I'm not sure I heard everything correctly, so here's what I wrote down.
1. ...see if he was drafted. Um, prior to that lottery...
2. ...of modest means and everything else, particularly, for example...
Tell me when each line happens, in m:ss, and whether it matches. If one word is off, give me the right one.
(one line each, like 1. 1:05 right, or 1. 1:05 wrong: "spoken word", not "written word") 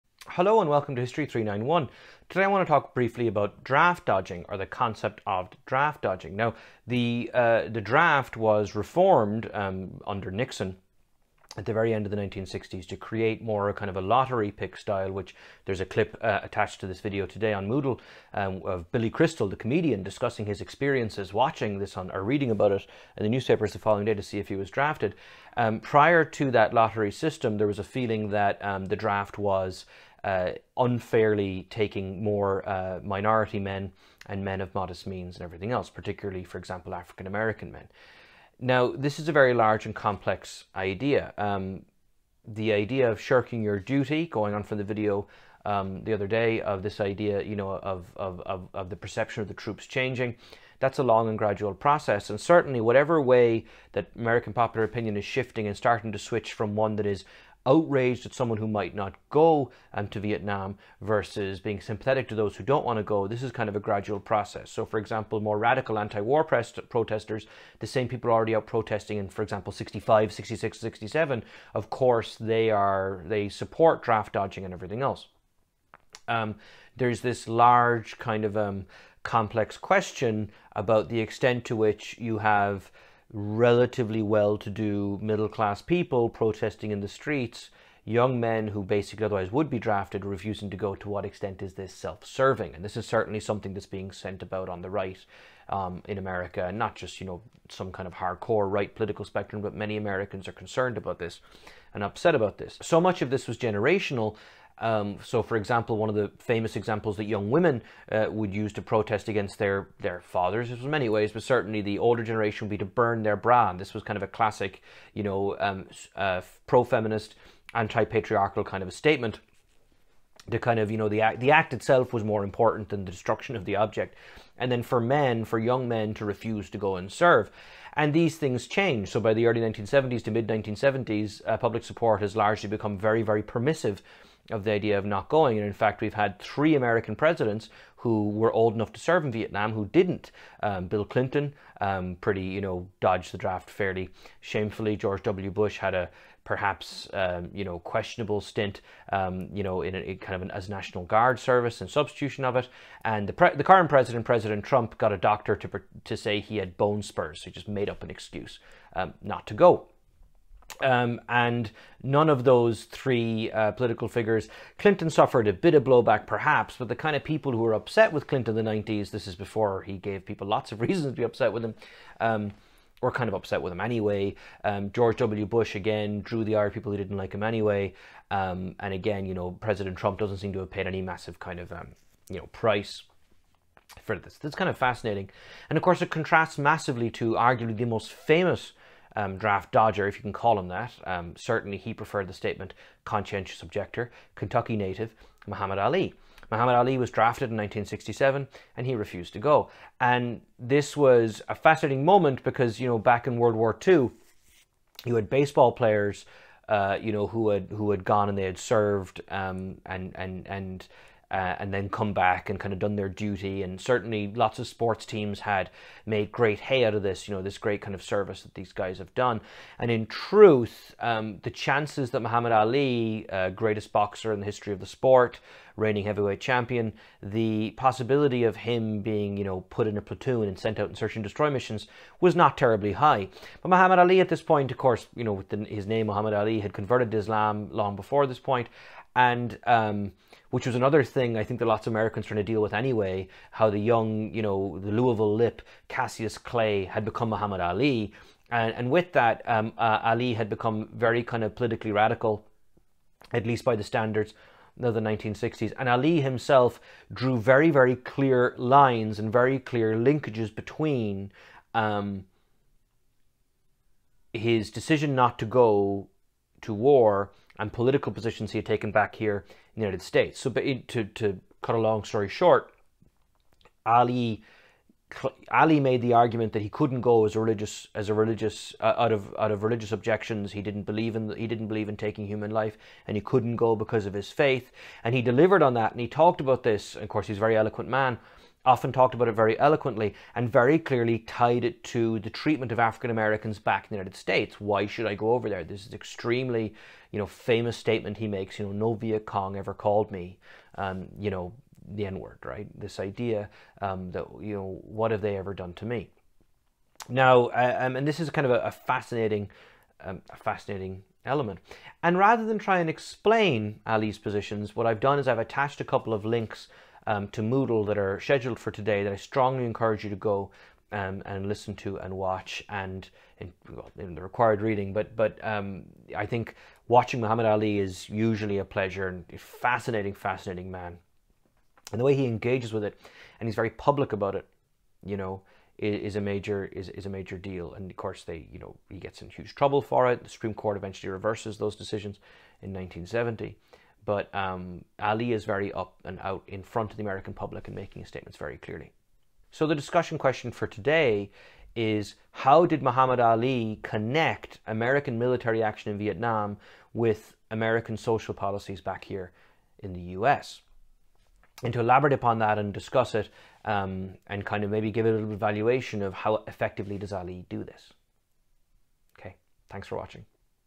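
1. 0:24 right
2. 0:34 right.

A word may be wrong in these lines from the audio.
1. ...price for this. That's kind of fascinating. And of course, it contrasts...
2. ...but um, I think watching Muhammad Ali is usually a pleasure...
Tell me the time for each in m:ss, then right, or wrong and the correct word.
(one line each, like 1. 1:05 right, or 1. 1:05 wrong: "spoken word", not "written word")
1. 3:02 right
2. 5:25 right.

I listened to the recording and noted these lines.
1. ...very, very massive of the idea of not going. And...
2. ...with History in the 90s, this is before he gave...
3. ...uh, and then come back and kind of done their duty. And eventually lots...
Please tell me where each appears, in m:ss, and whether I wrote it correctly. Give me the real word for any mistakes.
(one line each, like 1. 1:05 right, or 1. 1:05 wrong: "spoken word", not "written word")
1. 2:12 wrong: "permissive", not "massive"
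2. 2:48 wrong: "Clinton", not "History"
3. 3:31 wrong: "certainly", not "eventually".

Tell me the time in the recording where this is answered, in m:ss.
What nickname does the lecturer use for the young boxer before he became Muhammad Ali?
4:04.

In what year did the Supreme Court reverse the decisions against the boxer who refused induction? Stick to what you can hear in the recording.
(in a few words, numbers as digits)
1970.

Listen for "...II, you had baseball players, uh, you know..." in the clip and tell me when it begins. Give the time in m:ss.
3:23.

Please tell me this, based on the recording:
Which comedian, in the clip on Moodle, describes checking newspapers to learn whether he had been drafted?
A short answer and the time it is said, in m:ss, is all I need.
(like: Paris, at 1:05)
Billy Crystal, at 0:18.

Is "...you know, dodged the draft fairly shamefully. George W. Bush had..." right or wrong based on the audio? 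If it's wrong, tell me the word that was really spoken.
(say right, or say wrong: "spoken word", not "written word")
right.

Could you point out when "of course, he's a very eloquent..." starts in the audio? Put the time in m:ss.
4:46.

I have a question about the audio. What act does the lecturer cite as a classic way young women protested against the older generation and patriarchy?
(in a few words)
burn their bra.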